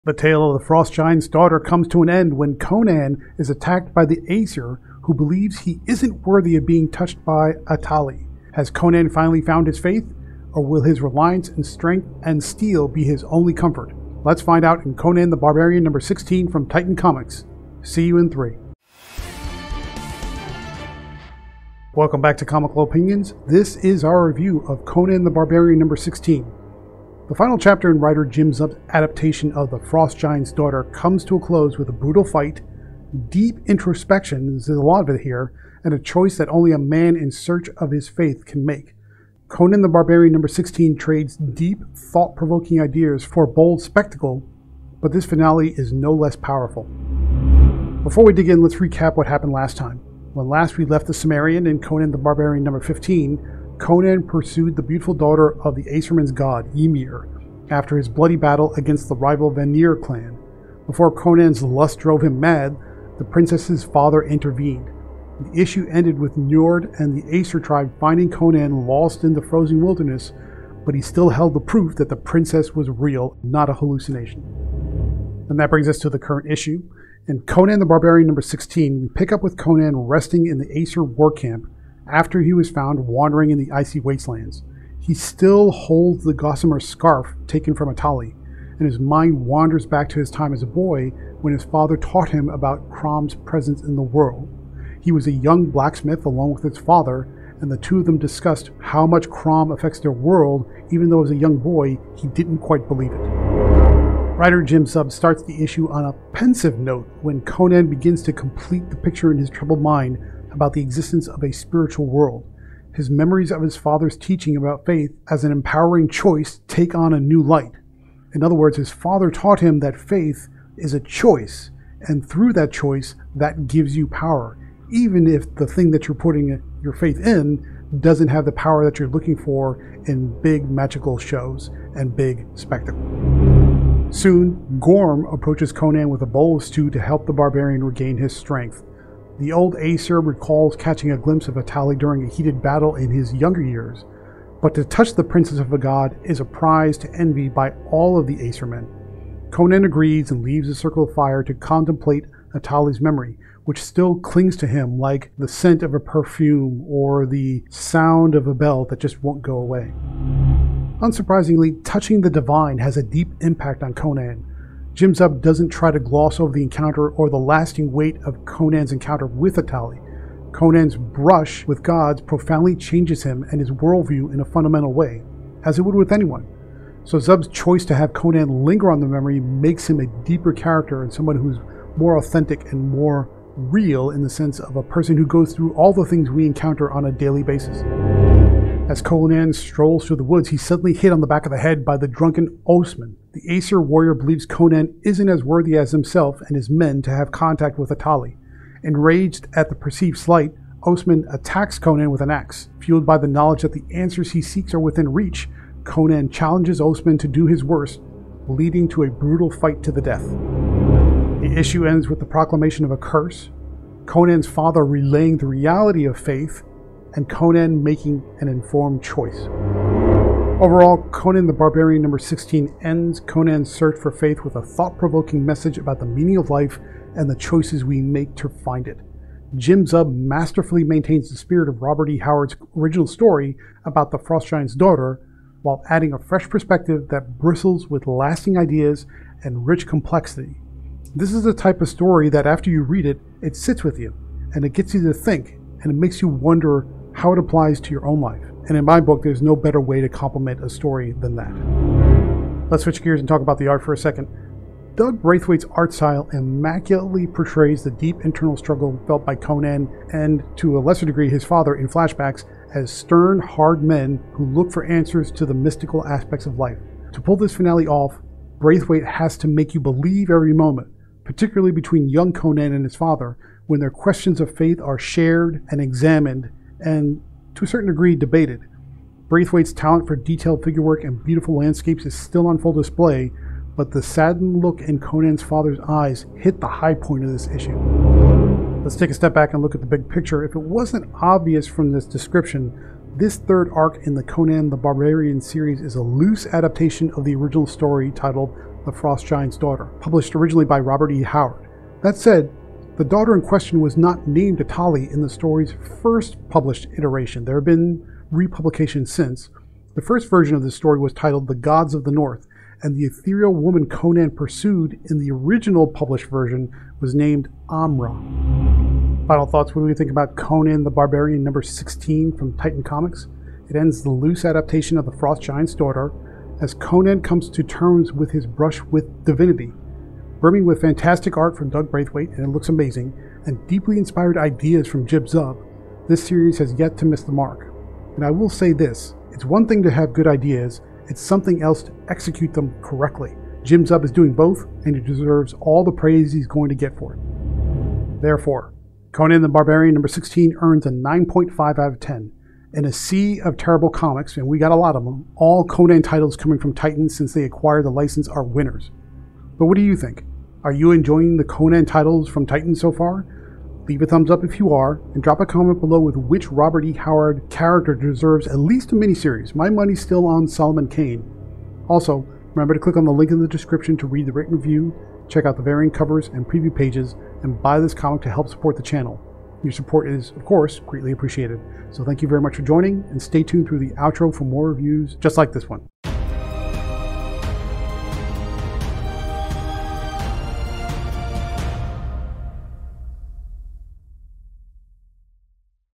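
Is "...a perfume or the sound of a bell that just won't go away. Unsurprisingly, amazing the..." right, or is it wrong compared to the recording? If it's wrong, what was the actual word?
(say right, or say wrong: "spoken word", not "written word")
wrong: "touching", not "amazing".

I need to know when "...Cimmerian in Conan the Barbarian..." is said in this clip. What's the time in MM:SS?
00:51.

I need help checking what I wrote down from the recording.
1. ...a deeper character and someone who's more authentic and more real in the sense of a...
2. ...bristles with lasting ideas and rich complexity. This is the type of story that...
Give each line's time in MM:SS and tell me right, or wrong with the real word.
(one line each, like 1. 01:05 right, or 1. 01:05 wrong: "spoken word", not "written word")
1. 03:00 right
2. 03:57 right.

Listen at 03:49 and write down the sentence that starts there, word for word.
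Jim Zub masterfully maintains the spirit of Robert E.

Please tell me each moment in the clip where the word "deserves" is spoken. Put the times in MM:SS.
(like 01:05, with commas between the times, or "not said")
05:45, 06:07.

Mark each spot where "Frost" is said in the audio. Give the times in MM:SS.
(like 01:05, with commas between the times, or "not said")
00:00, 00:29, 03:54, 04:58, 05:25.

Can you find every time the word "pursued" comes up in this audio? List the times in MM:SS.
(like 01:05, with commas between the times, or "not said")
00:54, 05:14.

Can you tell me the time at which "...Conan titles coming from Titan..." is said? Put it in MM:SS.
05:55.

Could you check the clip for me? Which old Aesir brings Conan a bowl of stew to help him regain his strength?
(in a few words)
Gorm.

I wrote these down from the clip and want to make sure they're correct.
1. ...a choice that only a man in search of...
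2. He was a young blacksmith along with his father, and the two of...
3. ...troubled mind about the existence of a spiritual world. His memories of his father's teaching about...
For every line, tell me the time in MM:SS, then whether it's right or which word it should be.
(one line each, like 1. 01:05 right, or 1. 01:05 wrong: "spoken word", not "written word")
1. 00:35 right
2. 01:35 right
3. 01:49 right.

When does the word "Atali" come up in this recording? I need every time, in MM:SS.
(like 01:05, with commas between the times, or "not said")
00:07, 01:27, 02:21, 02:32, 02:49, 03:17, 05:04.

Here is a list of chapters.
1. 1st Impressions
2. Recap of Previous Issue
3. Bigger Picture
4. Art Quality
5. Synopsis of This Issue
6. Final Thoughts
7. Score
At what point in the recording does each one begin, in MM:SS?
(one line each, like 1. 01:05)
1. 00:22
2. 00:48
3. 04:49
4. 04:12
5. 01:15
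6. 05:19
7. 05:50.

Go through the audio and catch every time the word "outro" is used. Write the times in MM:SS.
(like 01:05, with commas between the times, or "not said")
06:23.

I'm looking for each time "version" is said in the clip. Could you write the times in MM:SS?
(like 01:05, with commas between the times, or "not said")
05:10, 05:16.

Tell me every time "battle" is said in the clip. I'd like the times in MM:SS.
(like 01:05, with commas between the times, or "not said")
00:58, 02:22.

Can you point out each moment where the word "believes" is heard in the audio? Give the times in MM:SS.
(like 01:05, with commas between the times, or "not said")
00:05, 01:42, 03:14, 04:29.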